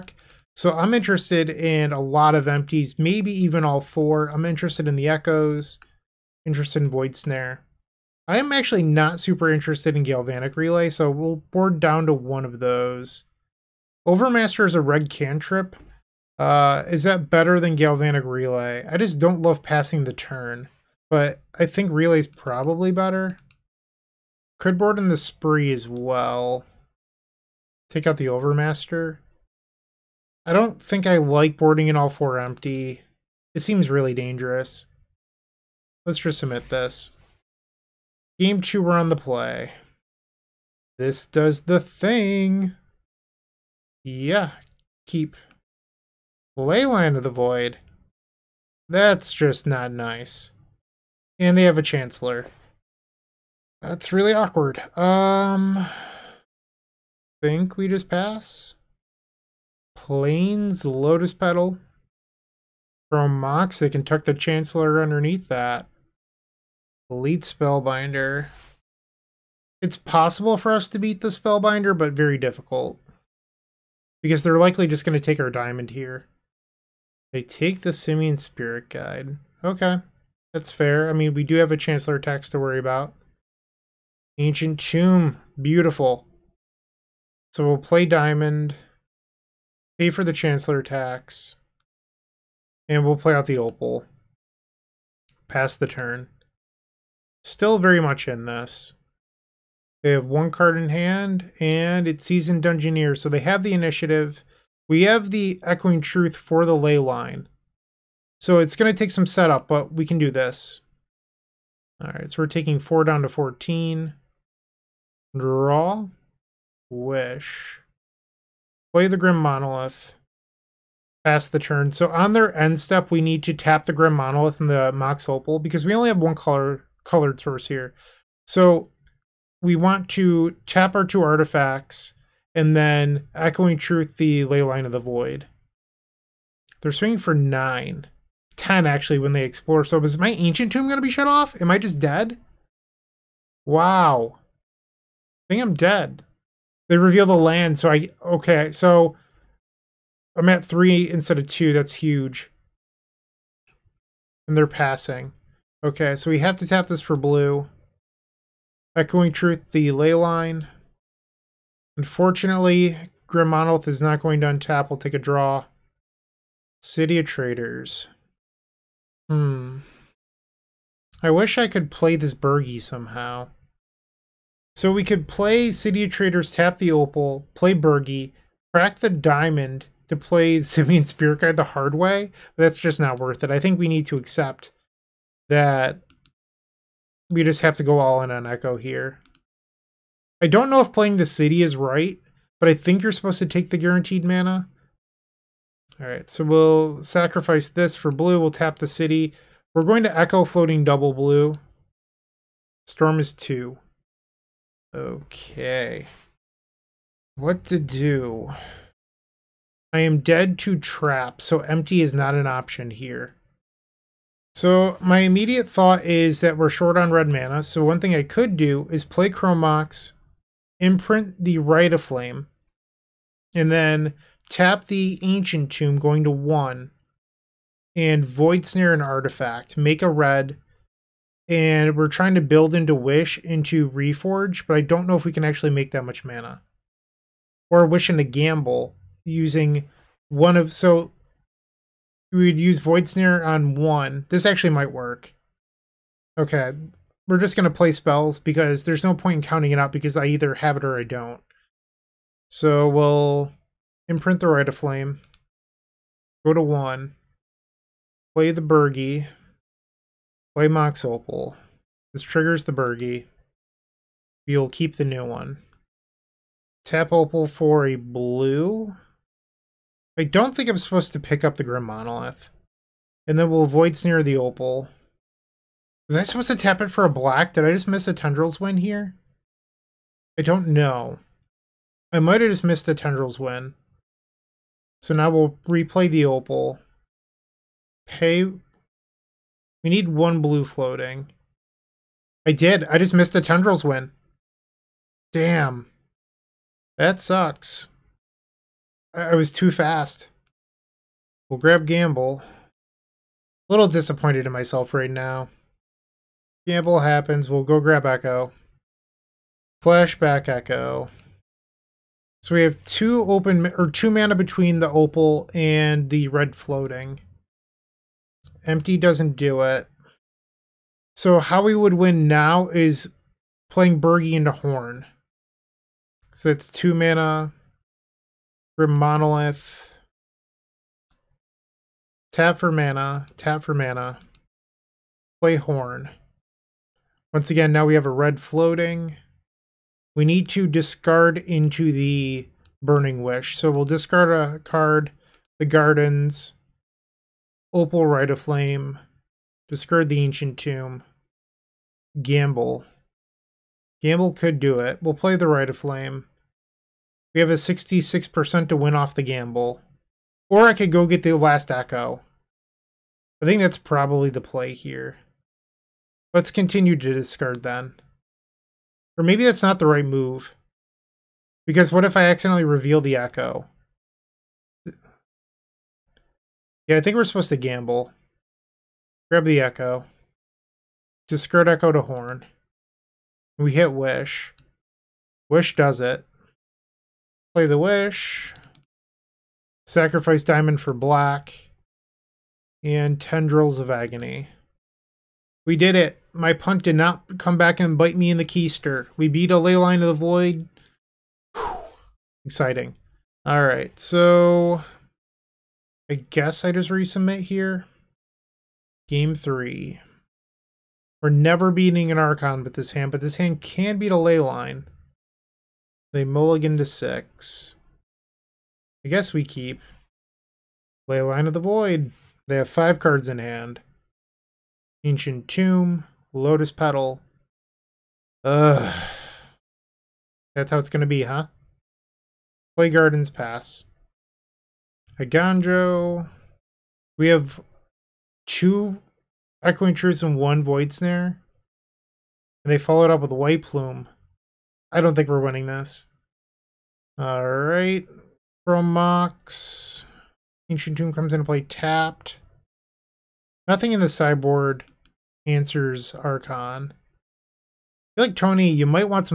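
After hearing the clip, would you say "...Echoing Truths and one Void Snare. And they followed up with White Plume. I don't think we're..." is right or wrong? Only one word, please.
right.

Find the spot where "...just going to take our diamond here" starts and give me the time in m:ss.
1:14.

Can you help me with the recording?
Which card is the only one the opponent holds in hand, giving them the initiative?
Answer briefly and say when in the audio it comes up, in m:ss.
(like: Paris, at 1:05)
Seasoned Dungeoneer, at 1:42.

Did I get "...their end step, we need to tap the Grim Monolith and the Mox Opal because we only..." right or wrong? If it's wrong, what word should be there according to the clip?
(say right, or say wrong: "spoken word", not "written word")
right.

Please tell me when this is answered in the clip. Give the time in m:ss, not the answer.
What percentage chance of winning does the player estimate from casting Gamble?
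5:57.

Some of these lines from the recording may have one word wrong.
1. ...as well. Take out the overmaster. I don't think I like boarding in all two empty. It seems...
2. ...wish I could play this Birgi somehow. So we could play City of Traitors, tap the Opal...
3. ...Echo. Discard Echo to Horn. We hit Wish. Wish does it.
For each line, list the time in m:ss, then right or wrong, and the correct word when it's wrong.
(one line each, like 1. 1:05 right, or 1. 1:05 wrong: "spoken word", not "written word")
1. 0:25 wrong: "four", not "two"
2. 2:51 right
3. 6:19 right.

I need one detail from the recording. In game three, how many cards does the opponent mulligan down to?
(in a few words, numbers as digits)
6.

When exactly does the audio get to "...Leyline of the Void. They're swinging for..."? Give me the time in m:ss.
2:14.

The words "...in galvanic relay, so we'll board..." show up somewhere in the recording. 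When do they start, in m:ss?
0:09.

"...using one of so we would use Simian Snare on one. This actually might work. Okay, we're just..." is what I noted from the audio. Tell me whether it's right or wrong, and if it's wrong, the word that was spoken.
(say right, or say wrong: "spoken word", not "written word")
wrong: "Void", not "Simian".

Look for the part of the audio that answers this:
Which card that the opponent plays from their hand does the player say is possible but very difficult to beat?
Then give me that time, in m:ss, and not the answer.
1:07.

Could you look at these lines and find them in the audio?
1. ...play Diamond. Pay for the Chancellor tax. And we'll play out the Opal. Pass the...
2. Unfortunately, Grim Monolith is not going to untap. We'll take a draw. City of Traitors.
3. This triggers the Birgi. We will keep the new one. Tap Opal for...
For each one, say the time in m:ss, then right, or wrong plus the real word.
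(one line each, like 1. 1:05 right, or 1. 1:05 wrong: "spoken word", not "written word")
1. 1:27 right
2. 2:41 right
3. 4:22 right.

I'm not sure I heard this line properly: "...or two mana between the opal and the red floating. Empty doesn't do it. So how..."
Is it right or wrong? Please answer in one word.
right.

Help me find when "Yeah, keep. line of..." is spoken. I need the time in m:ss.
0:44.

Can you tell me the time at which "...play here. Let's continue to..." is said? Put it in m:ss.
6:04.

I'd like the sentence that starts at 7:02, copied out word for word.
They have five cards in hand.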